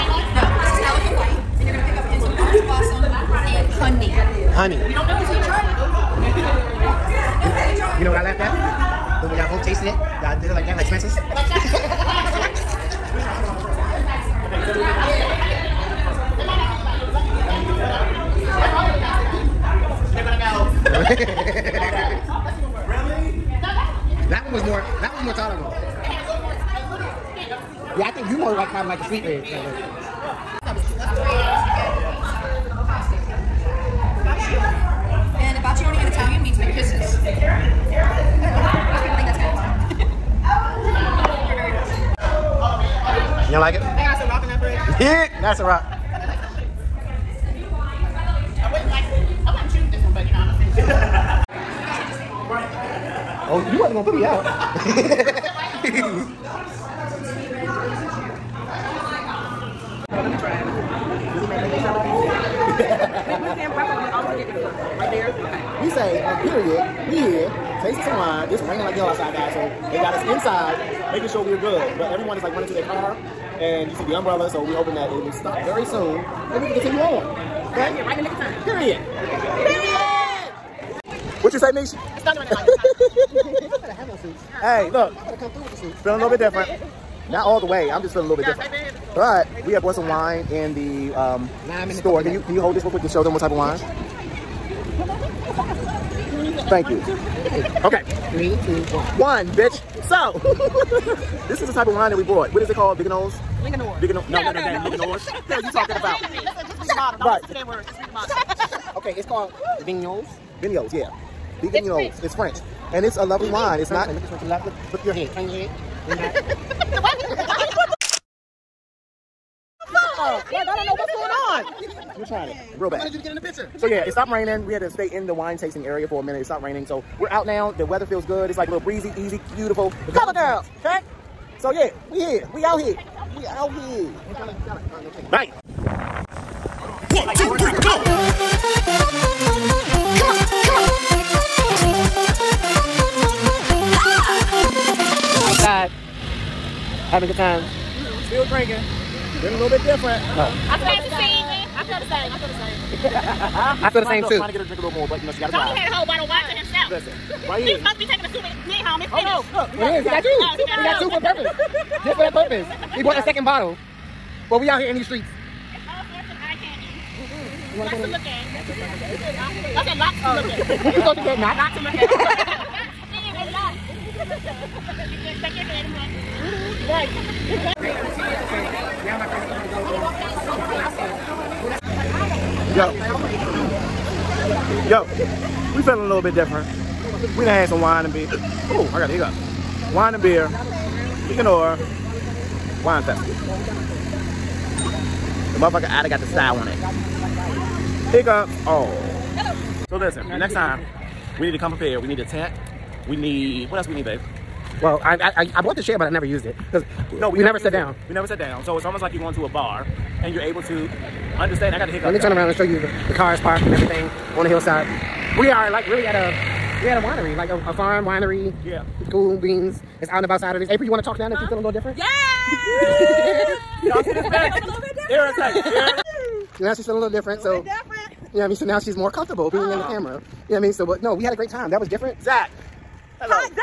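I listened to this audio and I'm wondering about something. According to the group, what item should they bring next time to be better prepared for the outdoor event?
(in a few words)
A tent.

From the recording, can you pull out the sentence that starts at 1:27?
I'm just feeling a little bit different.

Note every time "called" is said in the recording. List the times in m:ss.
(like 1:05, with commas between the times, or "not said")
1:42, 1:49.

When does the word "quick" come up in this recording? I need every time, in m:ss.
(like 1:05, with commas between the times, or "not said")
1:32.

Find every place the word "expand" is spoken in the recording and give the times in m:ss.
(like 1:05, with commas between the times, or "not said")
not said.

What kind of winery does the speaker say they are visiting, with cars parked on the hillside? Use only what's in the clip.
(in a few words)
A farm winery.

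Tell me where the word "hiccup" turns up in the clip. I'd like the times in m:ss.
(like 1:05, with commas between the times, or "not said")
3:09, 3:18, 3:31.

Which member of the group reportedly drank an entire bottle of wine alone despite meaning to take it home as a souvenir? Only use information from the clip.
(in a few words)
Tony.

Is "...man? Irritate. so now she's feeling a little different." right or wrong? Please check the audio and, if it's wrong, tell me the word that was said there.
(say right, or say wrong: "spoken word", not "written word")
right.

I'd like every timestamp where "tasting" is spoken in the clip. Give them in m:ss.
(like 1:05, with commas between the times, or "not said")
1:07, 2:05.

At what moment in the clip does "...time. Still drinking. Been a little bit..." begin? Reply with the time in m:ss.
2:27.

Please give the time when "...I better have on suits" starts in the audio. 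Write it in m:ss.
1:22.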